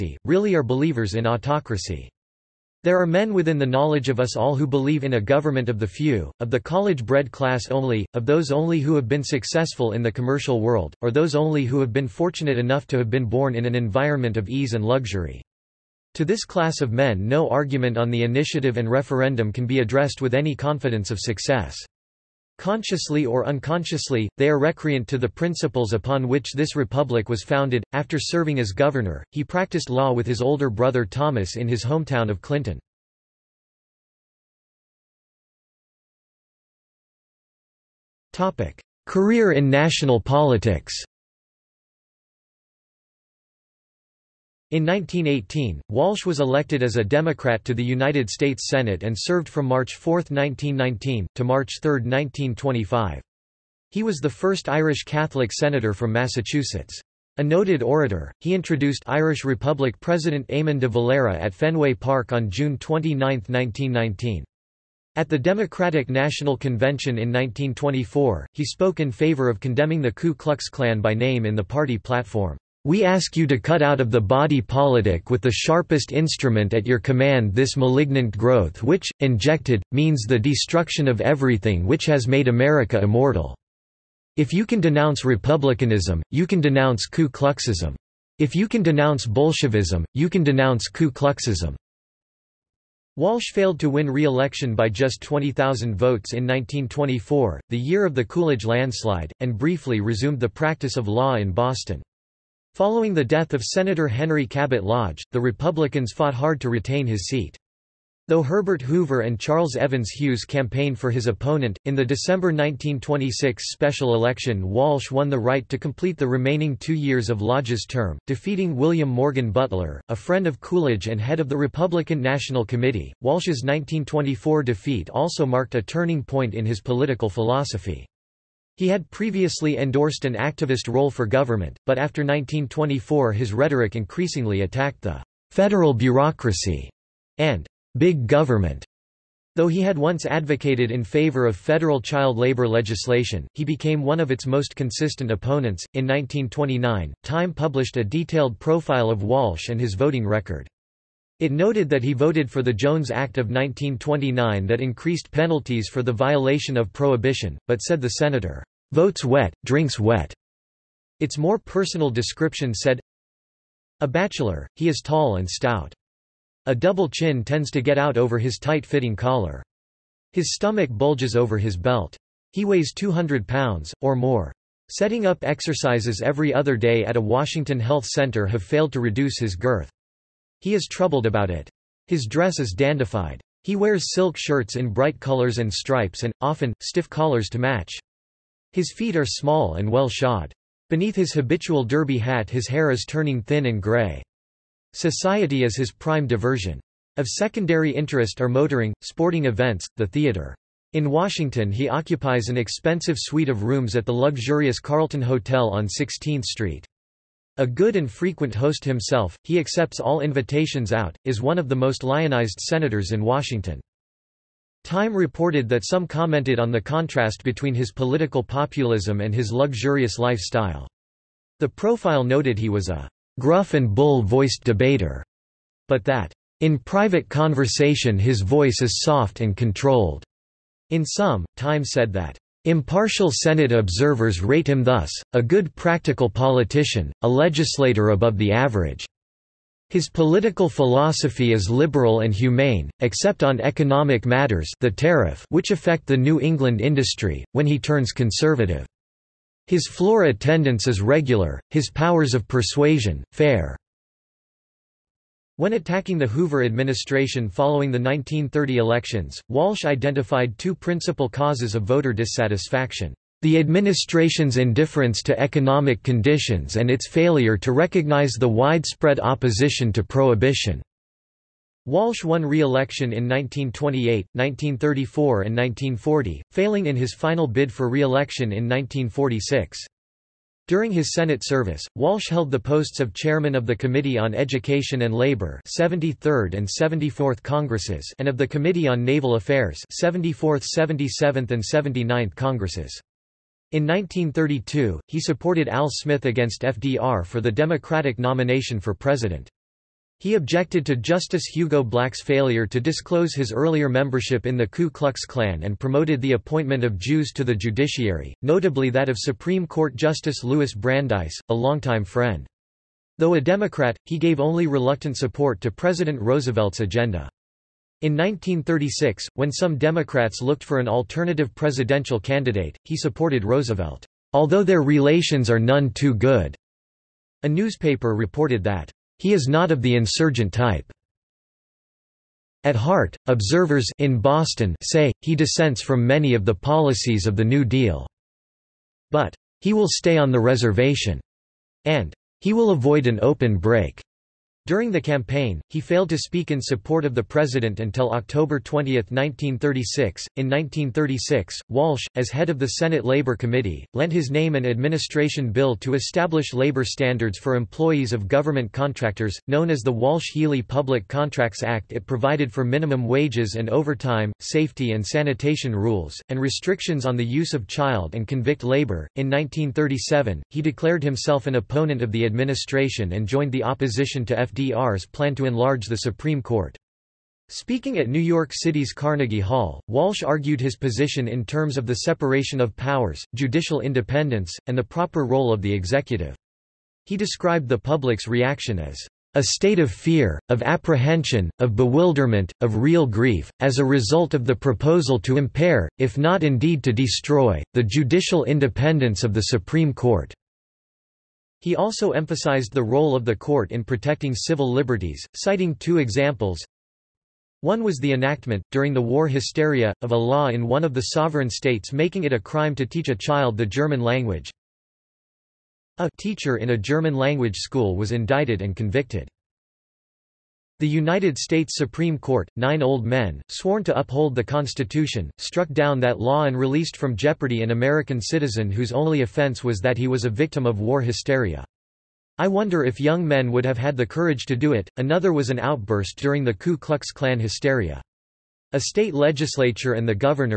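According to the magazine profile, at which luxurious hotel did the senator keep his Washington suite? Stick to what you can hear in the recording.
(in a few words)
Carlton Hotel.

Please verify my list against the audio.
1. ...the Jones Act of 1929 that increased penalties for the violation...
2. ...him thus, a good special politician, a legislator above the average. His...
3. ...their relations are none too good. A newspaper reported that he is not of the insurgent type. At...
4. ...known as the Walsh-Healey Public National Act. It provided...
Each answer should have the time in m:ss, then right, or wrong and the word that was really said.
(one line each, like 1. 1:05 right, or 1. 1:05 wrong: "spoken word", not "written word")
1. 2:32 right
2. 3:54 wrong: "practical", not "special"
3. 5:24 right
4. 5:59 wrong: "Contracts", not "National".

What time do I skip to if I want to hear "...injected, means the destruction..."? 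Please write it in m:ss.
1:19.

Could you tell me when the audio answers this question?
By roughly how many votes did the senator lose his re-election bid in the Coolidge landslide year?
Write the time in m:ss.
1:35.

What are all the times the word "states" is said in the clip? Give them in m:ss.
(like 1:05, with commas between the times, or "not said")
0:48, 6:29, 6:51, 7:01, 7:18.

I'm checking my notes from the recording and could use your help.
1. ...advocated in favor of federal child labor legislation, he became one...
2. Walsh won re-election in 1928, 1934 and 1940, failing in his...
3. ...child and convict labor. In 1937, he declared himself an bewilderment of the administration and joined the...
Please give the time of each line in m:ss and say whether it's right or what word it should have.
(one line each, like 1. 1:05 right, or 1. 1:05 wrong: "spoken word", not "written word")
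1. 2:20 right
2. 4:31 right
3. 6:07 wrong: "opponent", not "bewilderment".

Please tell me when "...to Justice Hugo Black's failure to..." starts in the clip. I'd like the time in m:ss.
5:00.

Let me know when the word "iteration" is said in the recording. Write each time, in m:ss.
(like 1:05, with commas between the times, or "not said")
not said.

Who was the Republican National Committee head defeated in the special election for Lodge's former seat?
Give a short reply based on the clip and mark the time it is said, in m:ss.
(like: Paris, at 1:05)
William Morgan Butler, at 1:58.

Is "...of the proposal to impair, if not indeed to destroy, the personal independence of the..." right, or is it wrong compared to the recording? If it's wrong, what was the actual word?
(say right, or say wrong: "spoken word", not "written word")
wrong: "judicial", not "personal".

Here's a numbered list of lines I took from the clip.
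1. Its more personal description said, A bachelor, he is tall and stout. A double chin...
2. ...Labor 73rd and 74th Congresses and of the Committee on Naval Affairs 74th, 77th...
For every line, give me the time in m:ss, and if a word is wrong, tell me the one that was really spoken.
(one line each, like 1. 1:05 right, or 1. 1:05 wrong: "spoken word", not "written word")
1. 2:41 right
2. 4:45 right.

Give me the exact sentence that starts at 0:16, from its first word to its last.
To this class of men no argument on the initiative and referendum can be addressed with any confidence of success.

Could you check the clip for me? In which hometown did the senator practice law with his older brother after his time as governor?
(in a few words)
Clinton.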